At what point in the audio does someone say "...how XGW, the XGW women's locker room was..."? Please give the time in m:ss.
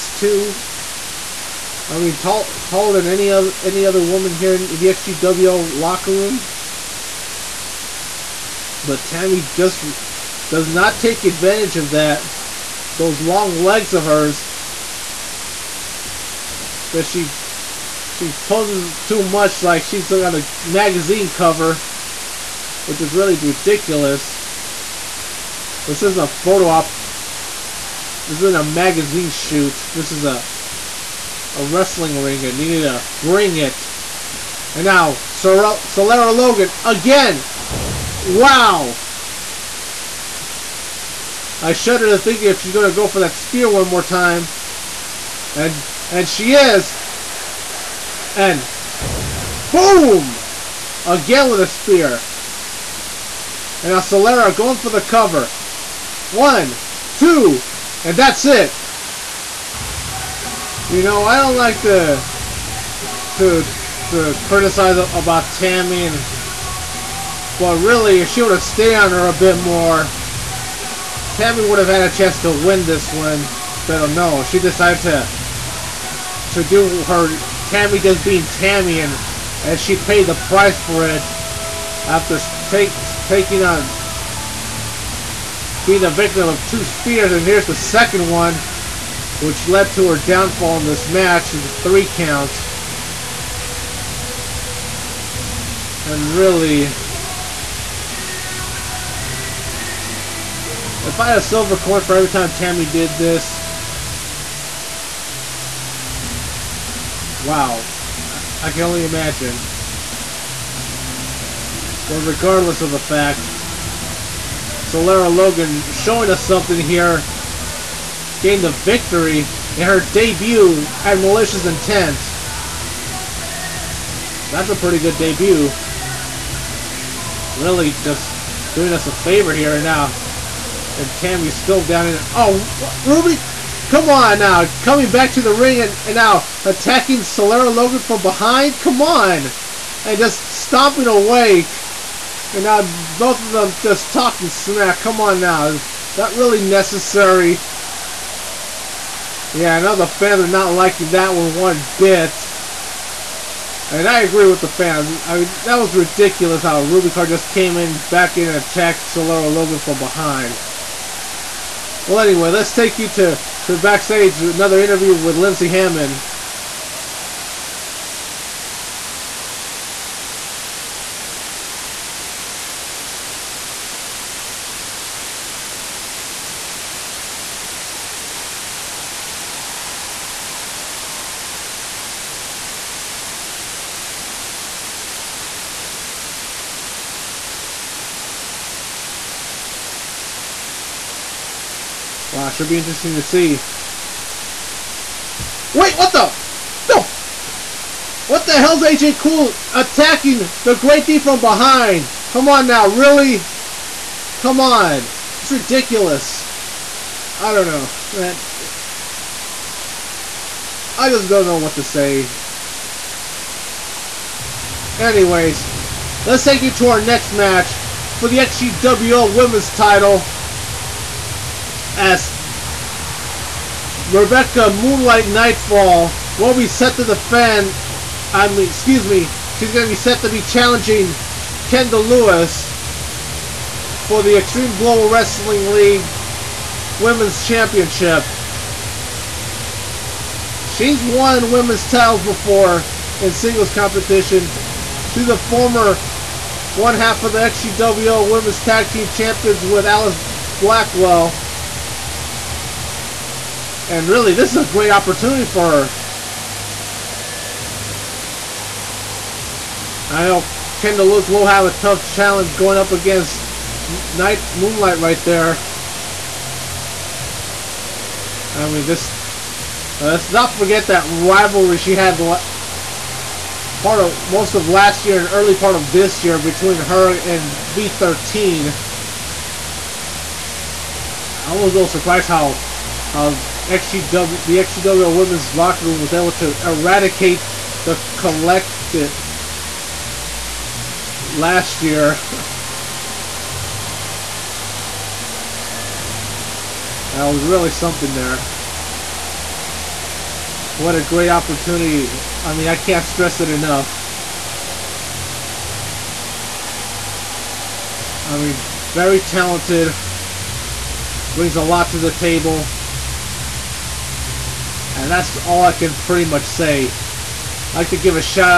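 4:43.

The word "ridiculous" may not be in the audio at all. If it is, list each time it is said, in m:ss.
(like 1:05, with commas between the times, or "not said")
0:23, 2:35, 3:25.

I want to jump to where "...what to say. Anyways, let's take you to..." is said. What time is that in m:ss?
3:31.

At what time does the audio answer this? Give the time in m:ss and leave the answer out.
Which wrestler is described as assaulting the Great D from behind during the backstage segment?
3:18.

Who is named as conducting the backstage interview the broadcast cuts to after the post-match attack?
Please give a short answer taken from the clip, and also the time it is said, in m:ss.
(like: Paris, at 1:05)
Lindsey Hammond, at 2:45.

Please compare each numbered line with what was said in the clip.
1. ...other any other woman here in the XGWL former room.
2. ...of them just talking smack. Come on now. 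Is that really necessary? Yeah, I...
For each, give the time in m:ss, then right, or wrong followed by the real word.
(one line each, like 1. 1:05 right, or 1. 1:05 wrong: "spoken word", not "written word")
1. 0:03 wrong: "locker", not "former"
2. 2:23 right.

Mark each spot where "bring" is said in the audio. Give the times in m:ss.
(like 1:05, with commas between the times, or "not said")
0:33, 5:11.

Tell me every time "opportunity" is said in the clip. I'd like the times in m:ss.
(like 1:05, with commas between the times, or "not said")
4:14, 5:01.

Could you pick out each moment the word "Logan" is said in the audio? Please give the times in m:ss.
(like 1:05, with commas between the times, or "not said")
0:36, 1:55, 2:17, 2:39.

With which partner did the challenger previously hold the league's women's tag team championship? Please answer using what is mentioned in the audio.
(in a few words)
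Alice Blackwell.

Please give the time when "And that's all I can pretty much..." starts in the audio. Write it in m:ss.
5:14.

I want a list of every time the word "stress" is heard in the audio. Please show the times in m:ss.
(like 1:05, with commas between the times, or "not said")
5:03.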